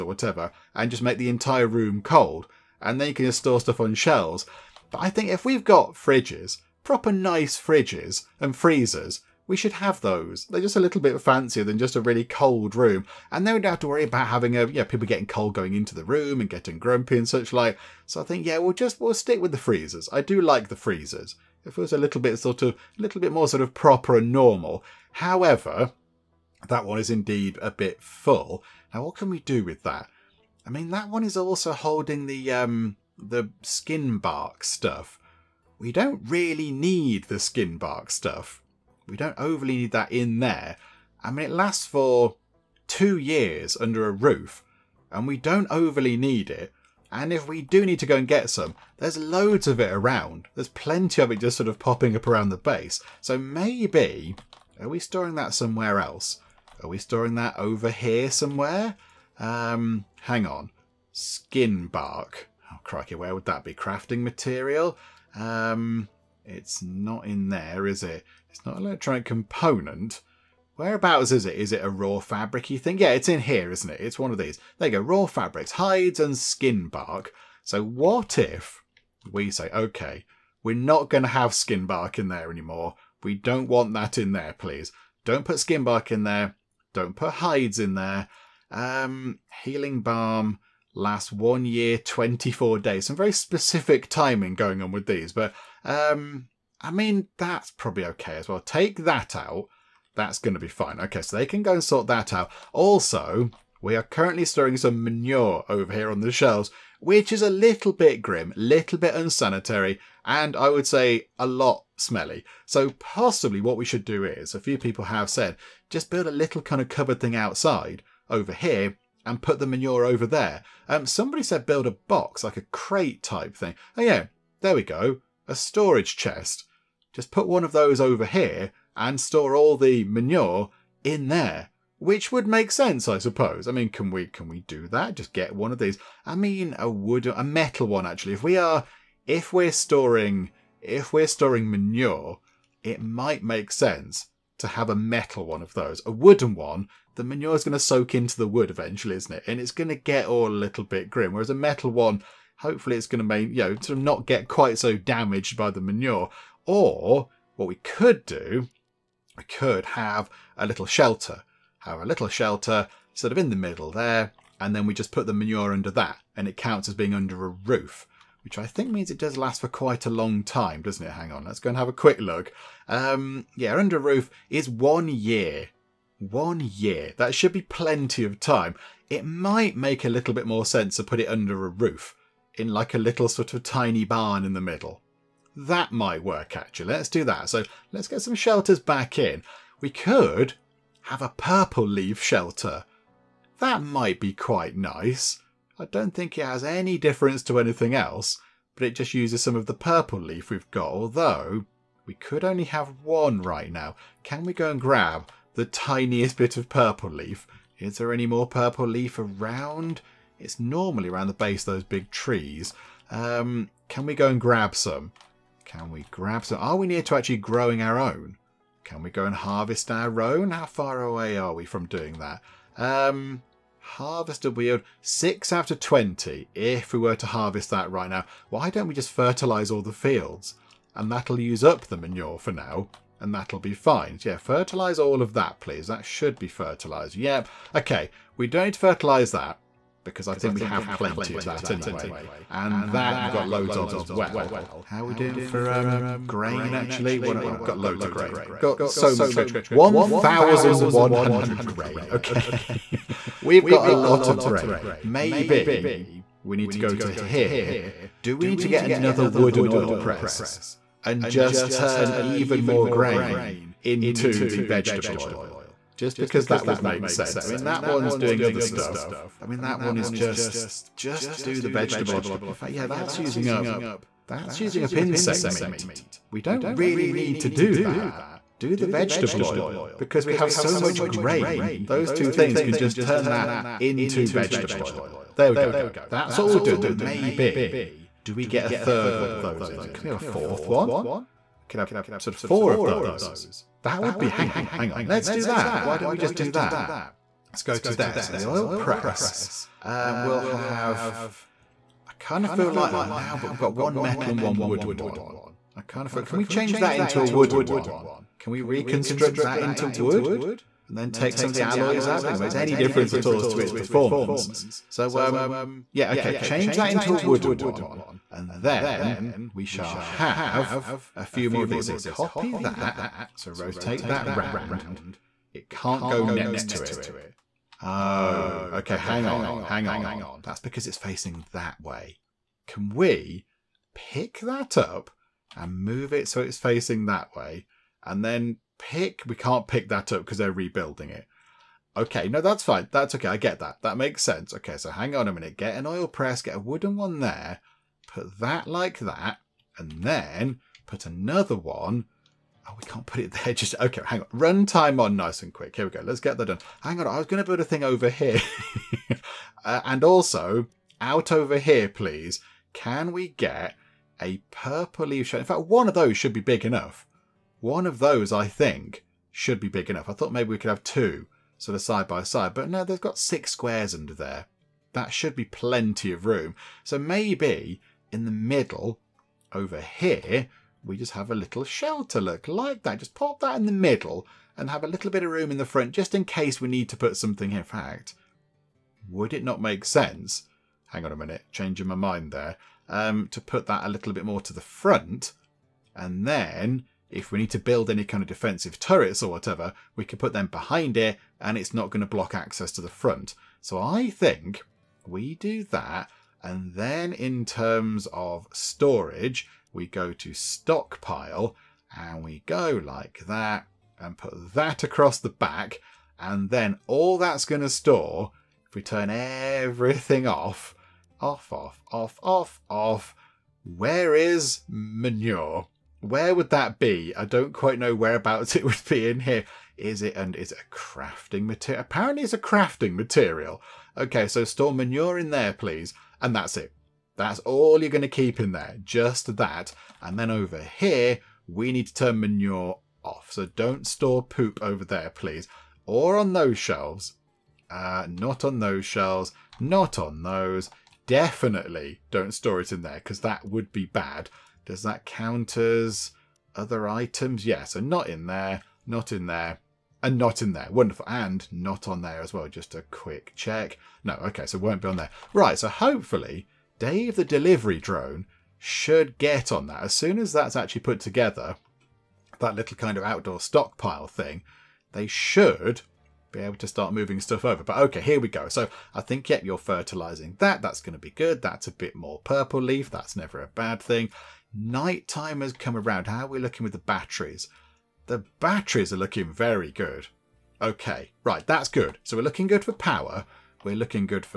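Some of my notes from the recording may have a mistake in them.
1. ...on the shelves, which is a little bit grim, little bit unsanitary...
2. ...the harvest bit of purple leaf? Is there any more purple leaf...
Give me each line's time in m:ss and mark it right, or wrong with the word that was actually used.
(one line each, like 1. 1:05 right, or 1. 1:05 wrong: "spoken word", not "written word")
1. 1:46 right
2. 3:25 wrong: "tiniest", not "harvest".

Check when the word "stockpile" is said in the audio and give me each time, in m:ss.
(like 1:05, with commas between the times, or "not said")
6:50, 7:53.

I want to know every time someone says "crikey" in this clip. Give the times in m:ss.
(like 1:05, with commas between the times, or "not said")
1:02.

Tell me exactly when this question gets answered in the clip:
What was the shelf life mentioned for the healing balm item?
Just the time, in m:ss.
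1:31.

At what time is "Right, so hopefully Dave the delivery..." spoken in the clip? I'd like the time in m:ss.
7:45.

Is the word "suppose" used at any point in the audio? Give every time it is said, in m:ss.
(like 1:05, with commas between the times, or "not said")
2:13.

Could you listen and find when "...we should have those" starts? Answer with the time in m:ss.
0:09.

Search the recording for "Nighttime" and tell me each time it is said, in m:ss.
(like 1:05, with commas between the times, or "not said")
8:04.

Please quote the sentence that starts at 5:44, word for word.
Okay, so hang on a minute.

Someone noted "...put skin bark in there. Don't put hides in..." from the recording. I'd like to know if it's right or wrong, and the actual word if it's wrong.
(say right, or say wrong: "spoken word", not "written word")
right.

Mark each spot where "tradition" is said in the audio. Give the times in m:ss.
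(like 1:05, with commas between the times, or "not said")
not said.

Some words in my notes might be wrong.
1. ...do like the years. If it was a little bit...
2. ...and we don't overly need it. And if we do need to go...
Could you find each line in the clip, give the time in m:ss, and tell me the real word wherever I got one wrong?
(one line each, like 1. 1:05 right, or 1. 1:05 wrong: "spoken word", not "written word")
1. 0:20 wrong: "freezers", not "years"
2. 0:45 right.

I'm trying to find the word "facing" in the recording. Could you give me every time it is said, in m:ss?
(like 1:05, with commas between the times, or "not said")
5:30, 5:36.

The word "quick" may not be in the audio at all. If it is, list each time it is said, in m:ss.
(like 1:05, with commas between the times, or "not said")
2:51, 5:55, 7:42.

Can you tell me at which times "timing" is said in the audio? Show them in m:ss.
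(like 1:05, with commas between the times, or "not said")
1:34.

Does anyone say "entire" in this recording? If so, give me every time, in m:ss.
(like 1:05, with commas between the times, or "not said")
0:01.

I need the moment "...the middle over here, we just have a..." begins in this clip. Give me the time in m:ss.
6:18.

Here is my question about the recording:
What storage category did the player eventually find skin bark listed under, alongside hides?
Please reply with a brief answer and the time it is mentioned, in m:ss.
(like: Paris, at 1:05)
raw fabrics, at 1:15.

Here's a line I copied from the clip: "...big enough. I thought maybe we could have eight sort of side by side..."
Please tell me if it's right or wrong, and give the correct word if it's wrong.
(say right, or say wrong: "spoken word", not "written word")
wrong: "two", not "eight".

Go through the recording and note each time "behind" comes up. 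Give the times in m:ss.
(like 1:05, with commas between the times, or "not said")
6:40.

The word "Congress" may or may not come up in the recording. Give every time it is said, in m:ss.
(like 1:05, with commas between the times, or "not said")
not said.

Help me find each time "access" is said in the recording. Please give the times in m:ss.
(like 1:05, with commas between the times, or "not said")
6:42.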